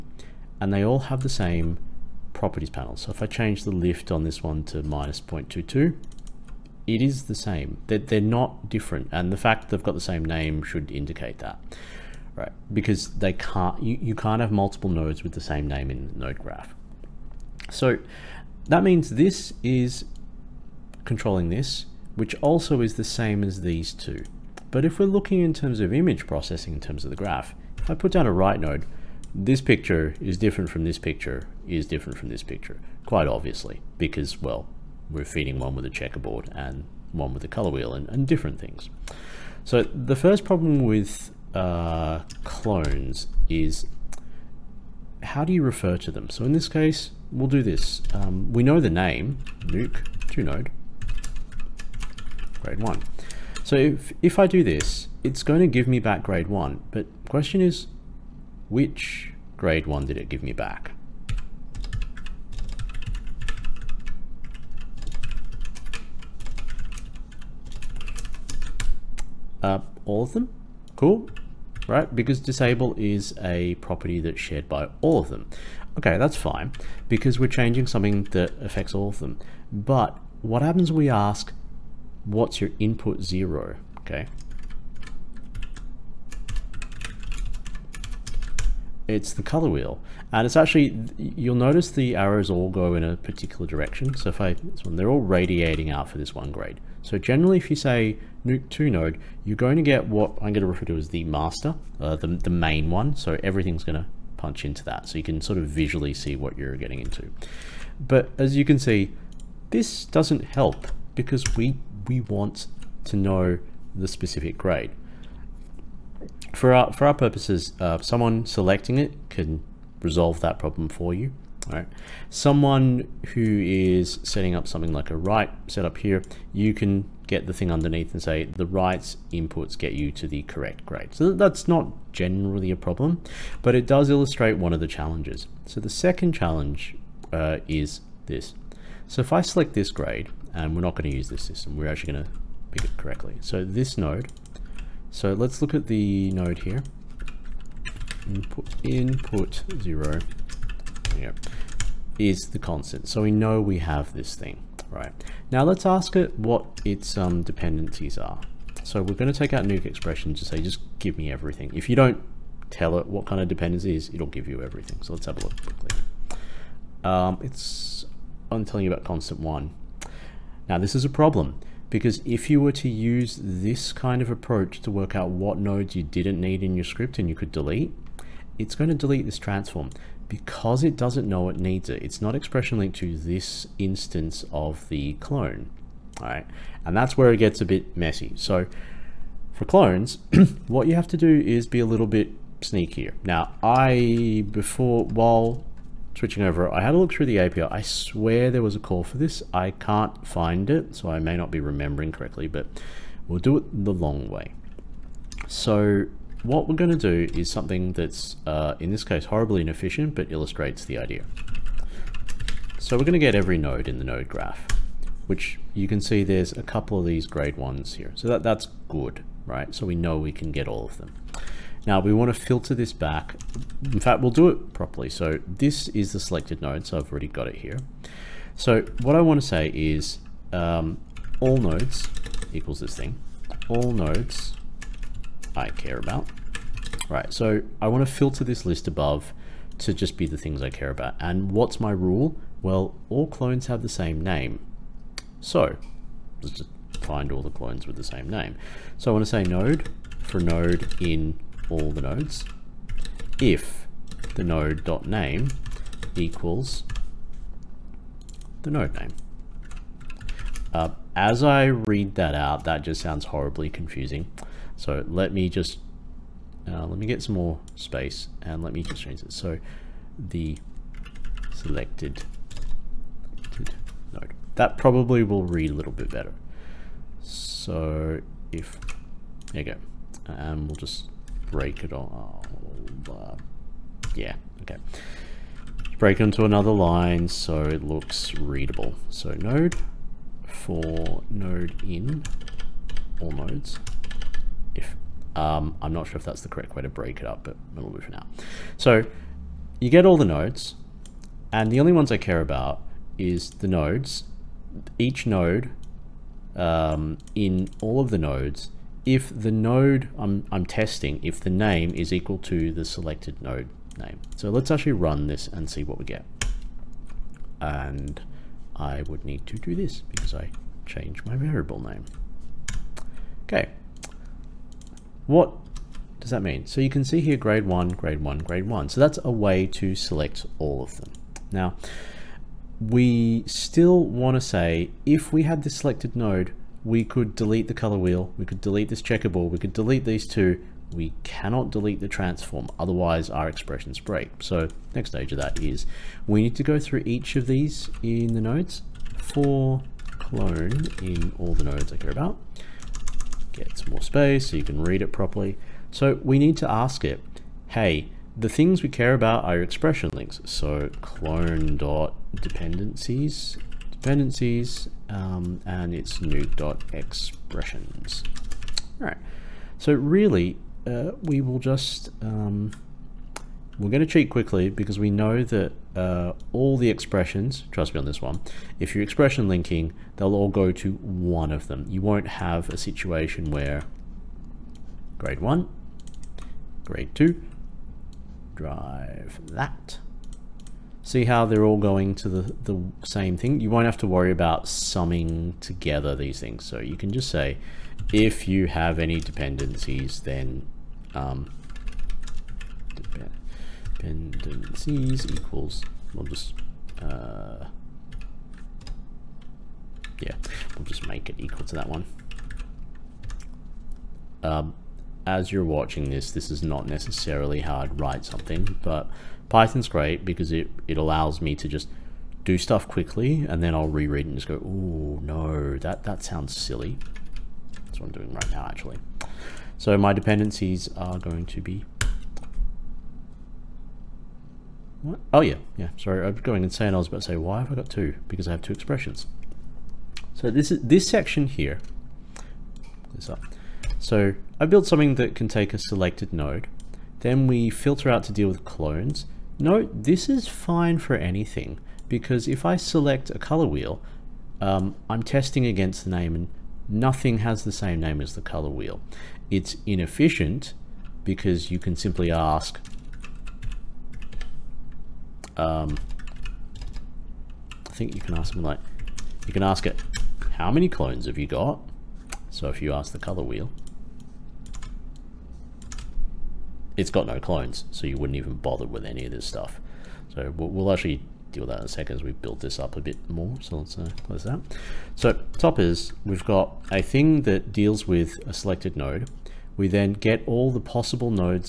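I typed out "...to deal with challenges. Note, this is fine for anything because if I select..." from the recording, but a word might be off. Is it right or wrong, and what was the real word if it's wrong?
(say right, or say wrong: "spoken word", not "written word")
wrong: "clones", not "challenges".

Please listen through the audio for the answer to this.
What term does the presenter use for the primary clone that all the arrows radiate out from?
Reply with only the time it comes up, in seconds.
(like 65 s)
101 s.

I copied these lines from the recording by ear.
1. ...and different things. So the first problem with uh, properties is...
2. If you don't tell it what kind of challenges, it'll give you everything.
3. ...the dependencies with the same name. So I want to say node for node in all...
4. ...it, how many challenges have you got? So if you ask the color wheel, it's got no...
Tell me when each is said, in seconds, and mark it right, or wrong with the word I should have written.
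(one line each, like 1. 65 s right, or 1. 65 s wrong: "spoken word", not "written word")
1. 38 s wrong: "clones", not "properties"
2. 161 s wrong: "dependencies", not "challenges"
3. 247 s wrong: "clones", not "dependencies"
4. 469 s wrong: "clones", not "challenges".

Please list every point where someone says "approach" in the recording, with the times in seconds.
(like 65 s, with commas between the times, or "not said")
174 s.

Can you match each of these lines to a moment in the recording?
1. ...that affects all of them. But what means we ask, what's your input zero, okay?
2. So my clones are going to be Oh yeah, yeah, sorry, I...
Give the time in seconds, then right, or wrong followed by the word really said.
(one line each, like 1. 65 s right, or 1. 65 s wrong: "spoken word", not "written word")
1. 78 s wrong: "happens", not "means"
2. 429 s wrong: "dependencies", not "clones".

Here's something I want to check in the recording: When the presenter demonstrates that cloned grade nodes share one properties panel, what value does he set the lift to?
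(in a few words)
-0.22.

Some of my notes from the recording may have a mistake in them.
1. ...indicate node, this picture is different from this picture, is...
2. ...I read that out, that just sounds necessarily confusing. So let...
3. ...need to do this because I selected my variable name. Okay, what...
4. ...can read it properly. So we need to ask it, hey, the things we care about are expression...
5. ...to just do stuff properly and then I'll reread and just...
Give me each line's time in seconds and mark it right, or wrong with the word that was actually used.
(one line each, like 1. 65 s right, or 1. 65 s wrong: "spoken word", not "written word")
1. 28 s wrong: "write", not "indicate"
2. 261 s wrong: "horribly", not "necessarily"
3. 319 s wrong: "changed", not "selected"
4. 354 s right
5. 421 s wrong: "quickly", not "properly".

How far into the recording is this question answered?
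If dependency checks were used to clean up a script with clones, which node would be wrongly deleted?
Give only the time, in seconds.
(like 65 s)
179 s.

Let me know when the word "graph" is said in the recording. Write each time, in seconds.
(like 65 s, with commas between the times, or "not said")
16 s, 27 s, 214 s.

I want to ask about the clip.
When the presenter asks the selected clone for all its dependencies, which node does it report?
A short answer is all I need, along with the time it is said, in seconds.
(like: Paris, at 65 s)
Constant one, at 169 s.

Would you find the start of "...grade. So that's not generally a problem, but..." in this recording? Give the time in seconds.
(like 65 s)
130 s.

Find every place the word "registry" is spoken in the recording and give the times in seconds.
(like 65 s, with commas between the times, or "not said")
not said.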